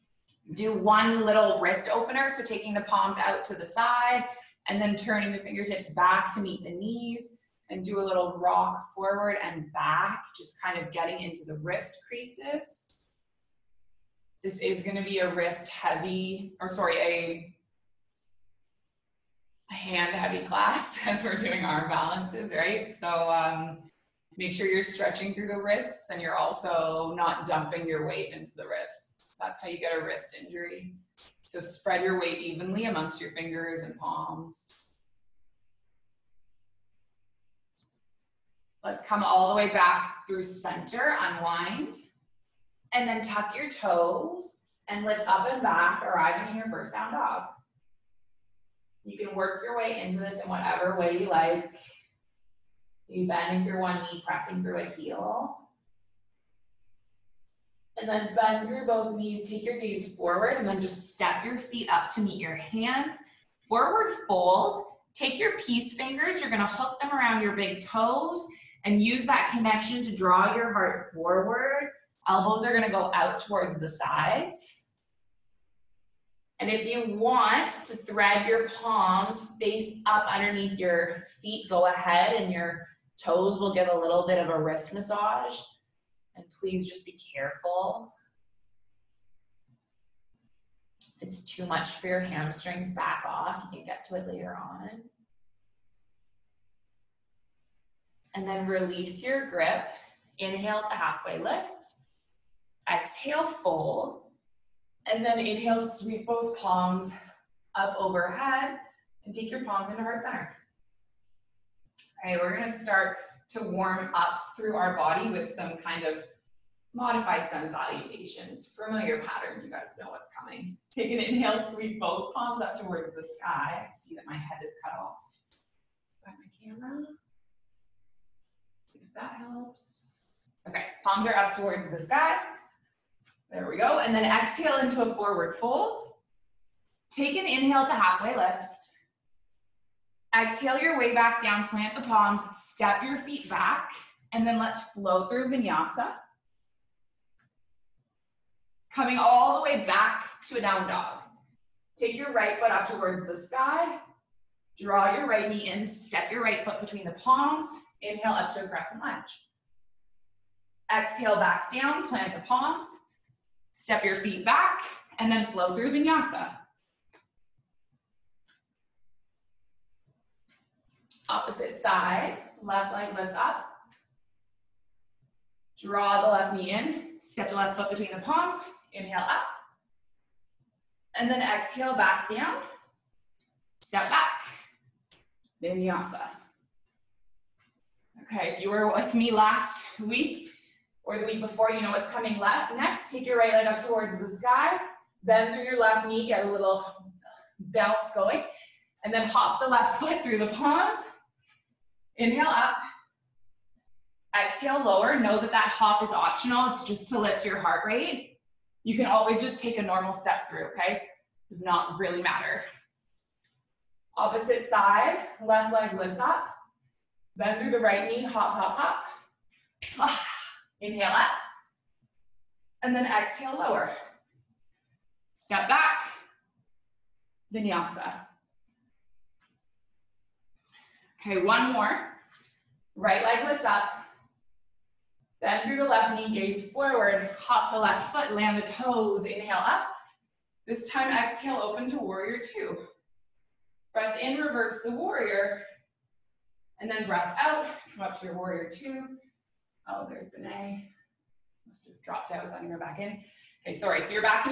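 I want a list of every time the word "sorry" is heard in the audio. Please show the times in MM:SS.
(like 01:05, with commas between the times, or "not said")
00:16, 04:13.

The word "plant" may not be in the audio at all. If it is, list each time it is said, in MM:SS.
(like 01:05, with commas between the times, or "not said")
02:21, 02:42.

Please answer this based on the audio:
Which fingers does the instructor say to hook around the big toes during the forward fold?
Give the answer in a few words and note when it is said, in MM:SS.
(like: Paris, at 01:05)
peace fingers, at 01:05.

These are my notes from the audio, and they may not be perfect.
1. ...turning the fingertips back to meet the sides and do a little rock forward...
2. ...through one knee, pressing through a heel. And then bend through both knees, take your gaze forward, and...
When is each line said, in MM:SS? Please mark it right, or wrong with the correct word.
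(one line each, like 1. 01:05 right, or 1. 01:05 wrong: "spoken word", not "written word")
1. 00:04 wrong: "knees", not "sides"
2. 00:53 right.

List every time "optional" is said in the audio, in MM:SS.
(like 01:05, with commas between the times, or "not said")
03:26.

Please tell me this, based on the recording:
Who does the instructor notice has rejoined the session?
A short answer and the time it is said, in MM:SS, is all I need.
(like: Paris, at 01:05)
Benay, at 04:10.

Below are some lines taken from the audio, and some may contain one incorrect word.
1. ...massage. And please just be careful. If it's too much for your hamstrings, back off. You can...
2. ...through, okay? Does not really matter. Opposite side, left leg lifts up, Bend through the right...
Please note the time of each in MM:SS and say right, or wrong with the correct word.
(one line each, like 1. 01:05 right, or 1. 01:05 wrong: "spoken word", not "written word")
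1. 01:24 right
2. 03:30 right.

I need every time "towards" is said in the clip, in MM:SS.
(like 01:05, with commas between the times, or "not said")
01:13, 02:02, 02:11, 02:32, 03:13.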